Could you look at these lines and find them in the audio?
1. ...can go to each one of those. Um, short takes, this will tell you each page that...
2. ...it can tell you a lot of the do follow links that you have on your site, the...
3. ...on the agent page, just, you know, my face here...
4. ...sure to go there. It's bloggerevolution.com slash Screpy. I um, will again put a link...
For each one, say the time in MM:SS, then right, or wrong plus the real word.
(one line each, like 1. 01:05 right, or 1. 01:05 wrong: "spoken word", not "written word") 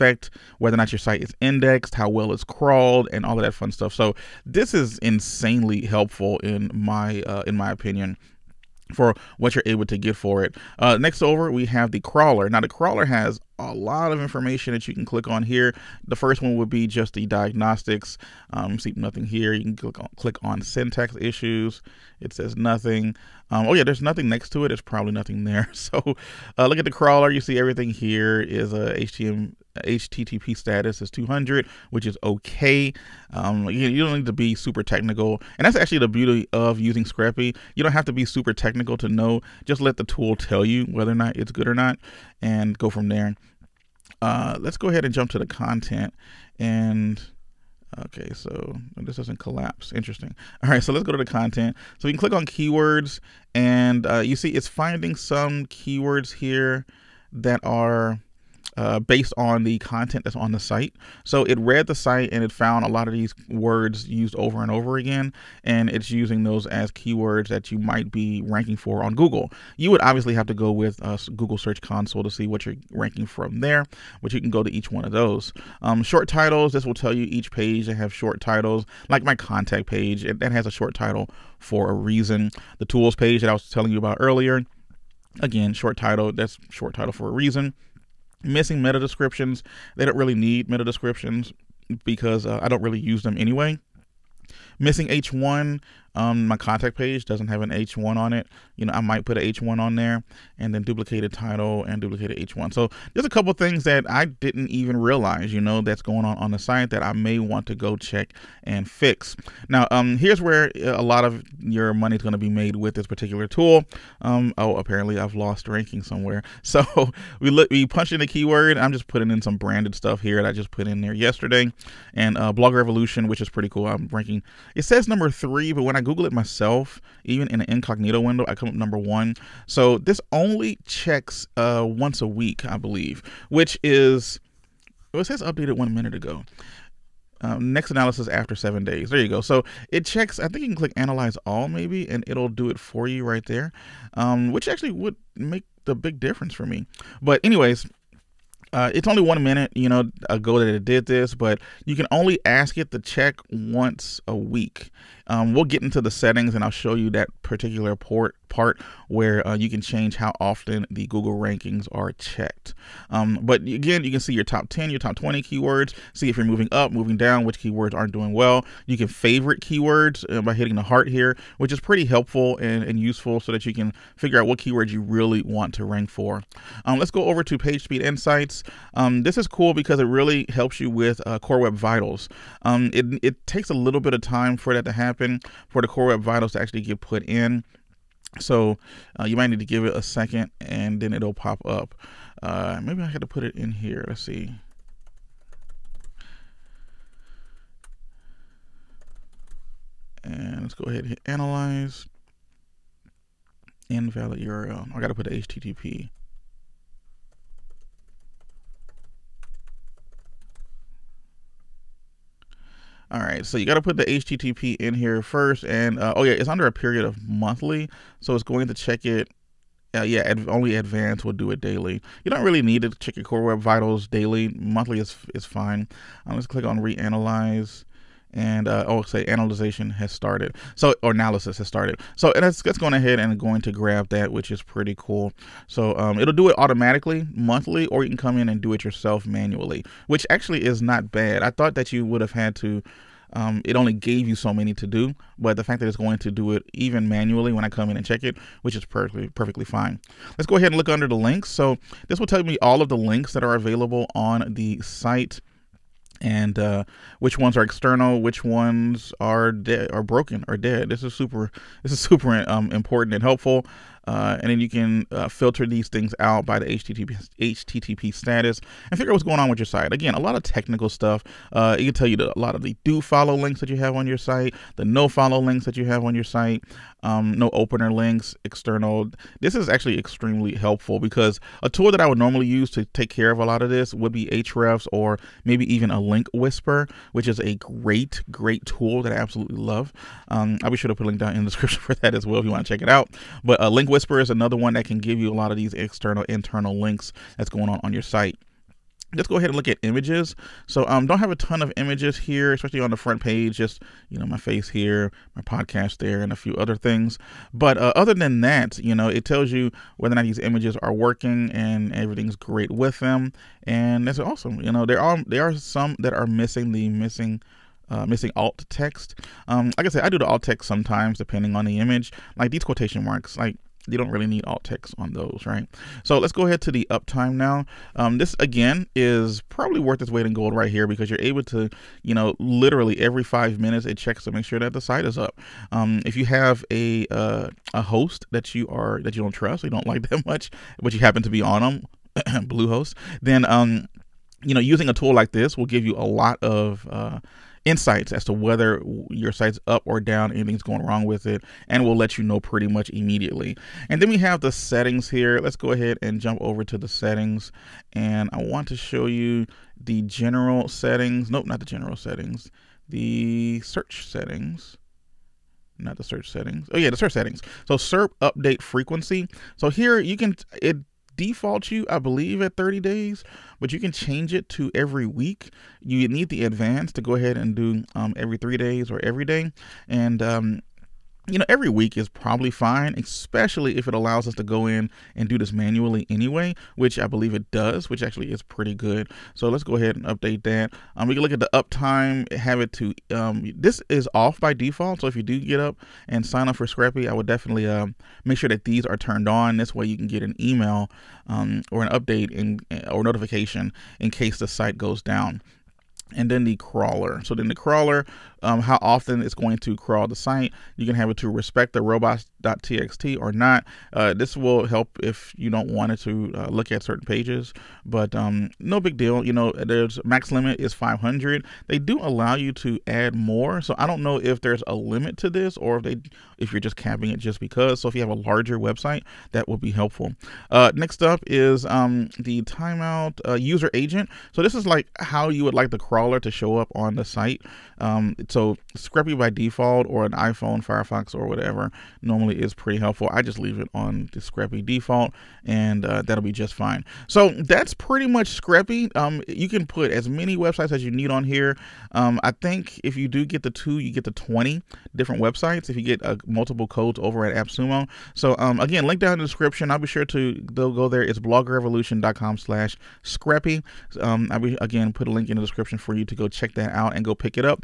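1. 01:14 wrong: "titles", not "takes"
2. 04:31 right
3. 05:02 wrong: "front", not "agent"
4. 07:39 right.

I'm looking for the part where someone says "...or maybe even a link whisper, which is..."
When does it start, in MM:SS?
04:44.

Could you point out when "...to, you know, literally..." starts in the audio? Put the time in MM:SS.
05:31.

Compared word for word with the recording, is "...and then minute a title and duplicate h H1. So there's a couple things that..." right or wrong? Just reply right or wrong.
wrong.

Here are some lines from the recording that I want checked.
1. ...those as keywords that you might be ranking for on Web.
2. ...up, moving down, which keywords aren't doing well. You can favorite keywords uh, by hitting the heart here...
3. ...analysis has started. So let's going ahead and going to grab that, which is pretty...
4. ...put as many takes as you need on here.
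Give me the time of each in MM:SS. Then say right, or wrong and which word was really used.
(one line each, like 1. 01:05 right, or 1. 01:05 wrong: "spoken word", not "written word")
1. 01:06 wrong: "Google", not "Web"
2. 02:46 right
3. 03:51 right
4. 07:29 wrong: "websites", not "takes".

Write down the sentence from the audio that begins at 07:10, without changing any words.
Uh, next up is um, the timeout uh, user agent.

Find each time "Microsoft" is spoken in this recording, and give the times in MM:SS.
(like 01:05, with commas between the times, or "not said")
not said.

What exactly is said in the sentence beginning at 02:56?
Um, let's go over to PageSpeed Insights.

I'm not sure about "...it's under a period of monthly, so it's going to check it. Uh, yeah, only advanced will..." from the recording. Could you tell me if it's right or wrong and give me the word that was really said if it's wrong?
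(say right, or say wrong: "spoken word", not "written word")
right.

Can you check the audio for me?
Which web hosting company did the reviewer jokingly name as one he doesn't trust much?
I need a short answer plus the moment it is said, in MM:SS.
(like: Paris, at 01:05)
Bluehost, at 05:42.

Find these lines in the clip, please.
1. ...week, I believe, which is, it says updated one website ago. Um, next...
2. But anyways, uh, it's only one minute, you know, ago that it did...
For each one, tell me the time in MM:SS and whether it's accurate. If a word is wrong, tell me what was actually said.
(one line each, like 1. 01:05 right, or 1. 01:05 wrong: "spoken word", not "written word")
1. 02:12 wrong: "minute", not "website"
2. 02:27 right.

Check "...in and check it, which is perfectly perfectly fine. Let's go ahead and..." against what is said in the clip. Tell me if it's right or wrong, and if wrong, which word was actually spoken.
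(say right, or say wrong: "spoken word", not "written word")
right.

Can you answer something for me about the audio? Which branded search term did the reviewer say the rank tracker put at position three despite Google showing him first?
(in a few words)
Blogger Evolution.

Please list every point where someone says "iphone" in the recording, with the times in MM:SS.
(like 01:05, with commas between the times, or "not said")
07:20.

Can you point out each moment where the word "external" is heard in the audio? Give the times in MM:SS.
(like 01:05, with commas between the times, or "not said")
04:17, 04:38, 04:55.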